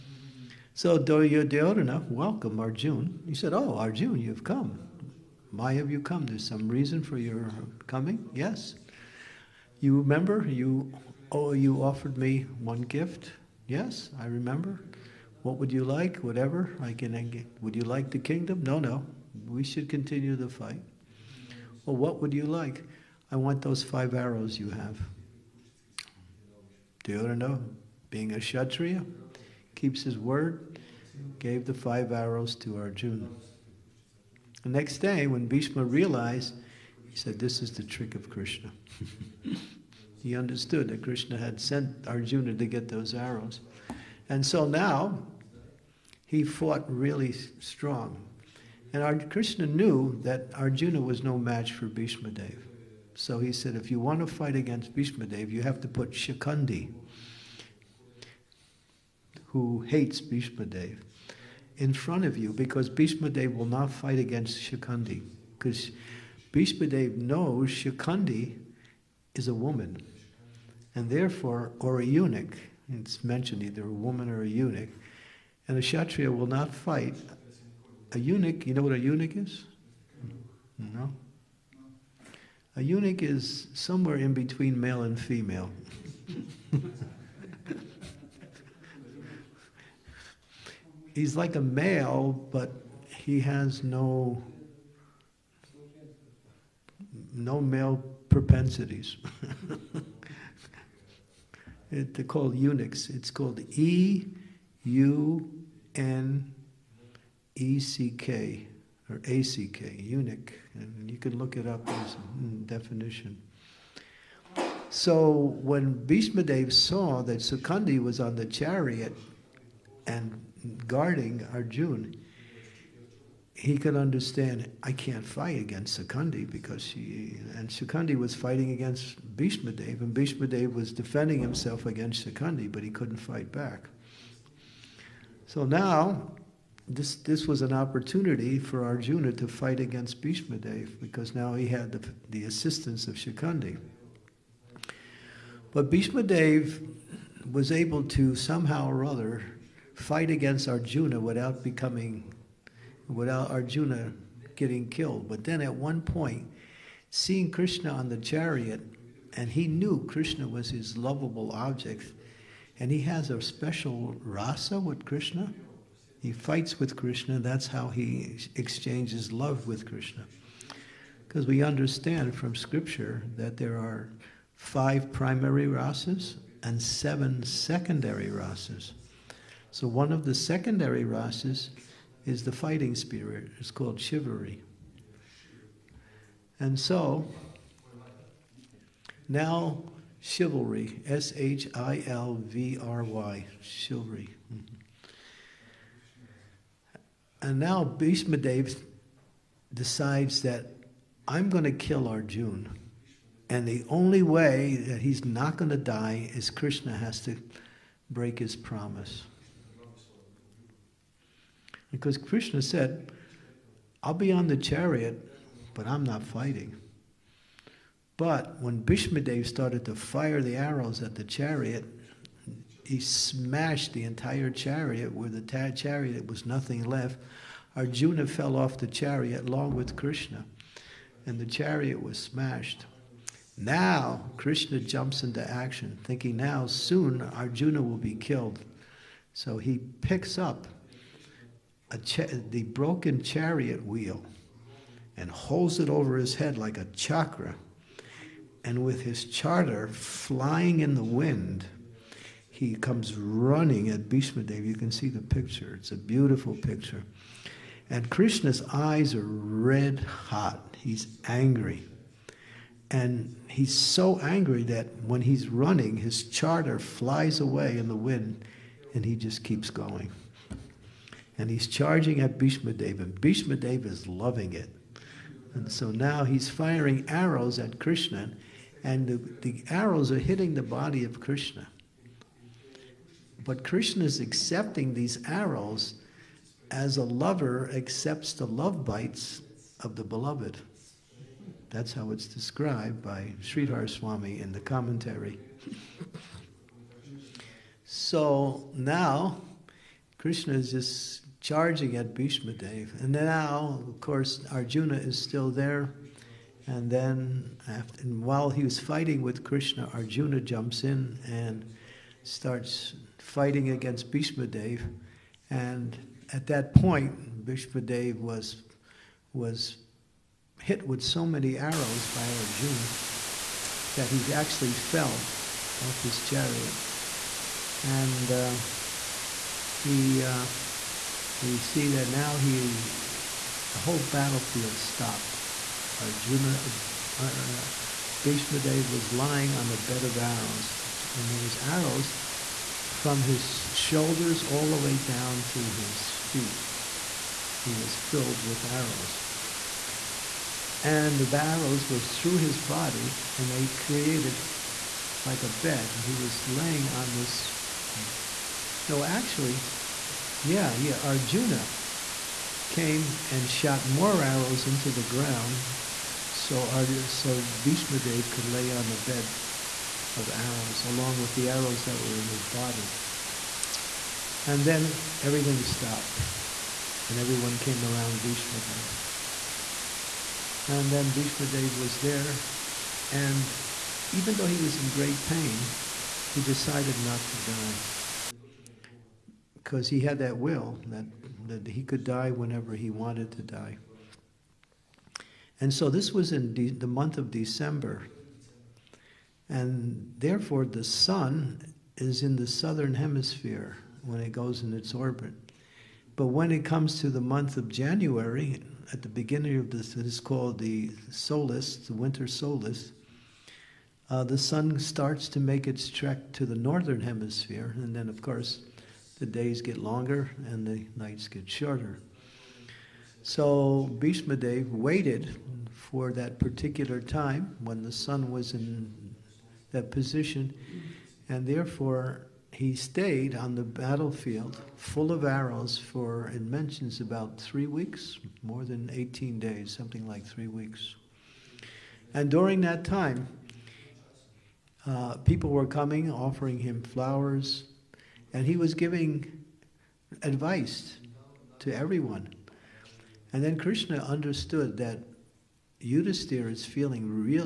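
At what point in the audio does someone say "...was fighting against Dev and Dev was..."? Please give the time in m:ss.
2:08.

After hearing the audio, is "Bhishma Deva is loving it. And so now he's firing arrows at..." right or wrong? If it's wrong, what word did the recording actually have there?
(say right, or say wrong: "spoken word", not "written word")
right.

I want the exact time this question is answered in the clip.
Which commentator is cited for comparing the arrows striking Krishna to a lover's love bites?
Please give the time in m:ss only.
4:53.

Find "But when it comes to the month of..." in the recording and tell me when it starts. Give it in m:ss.
6:46.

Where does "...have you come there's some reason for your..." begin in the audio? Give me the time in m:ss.
0:05.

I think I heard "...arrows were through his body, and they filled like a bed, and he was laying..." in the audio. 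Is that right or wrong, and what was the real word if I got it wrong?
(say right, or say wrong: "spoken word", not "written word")
wrong: "created", not "filled".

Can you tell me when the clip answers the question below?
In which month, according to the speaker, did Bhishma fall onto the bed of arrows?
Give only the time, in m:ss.
6:37.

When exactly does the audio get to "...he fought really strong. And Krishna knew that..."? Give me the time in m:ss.
0:46.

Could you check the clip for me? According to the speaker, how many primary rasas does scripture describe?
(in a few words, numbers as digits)
5.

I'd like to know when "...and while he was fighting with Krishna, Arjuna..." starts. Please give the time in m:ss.
5:08.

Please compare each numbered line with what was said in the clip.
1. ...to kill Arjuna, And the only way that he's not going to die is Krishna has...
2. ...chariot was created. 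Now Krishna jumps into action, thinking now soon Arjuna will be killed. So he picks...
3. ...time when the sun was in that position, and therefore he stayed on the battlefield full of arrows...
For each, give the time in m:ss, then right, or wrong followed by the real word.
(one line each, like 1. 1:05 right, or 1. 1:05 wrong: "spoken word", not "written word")
1. 3:21 right
2. 3:51 wrong: "smashed", not "created"
3. 7:06 right.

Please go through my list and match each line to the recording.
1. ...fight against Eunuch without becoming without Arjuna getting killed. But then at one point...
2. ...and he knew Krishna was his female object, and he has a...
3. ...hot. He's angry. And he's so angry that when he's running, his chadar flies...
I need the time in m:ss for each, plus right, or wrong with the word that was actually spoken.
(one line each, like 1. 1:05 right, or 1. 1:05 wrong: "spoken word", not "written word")
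1. 2:29 wrong: "Arjuna", not "Eunuch"
2. 2:39 wrong: "lovable", not "female"
3. 4:19 right.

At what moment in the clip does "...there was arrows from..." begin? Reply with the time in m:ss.
5:41.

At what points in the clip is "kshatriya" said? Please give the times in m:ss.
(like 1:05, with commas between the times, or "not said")
0:28, 1:15.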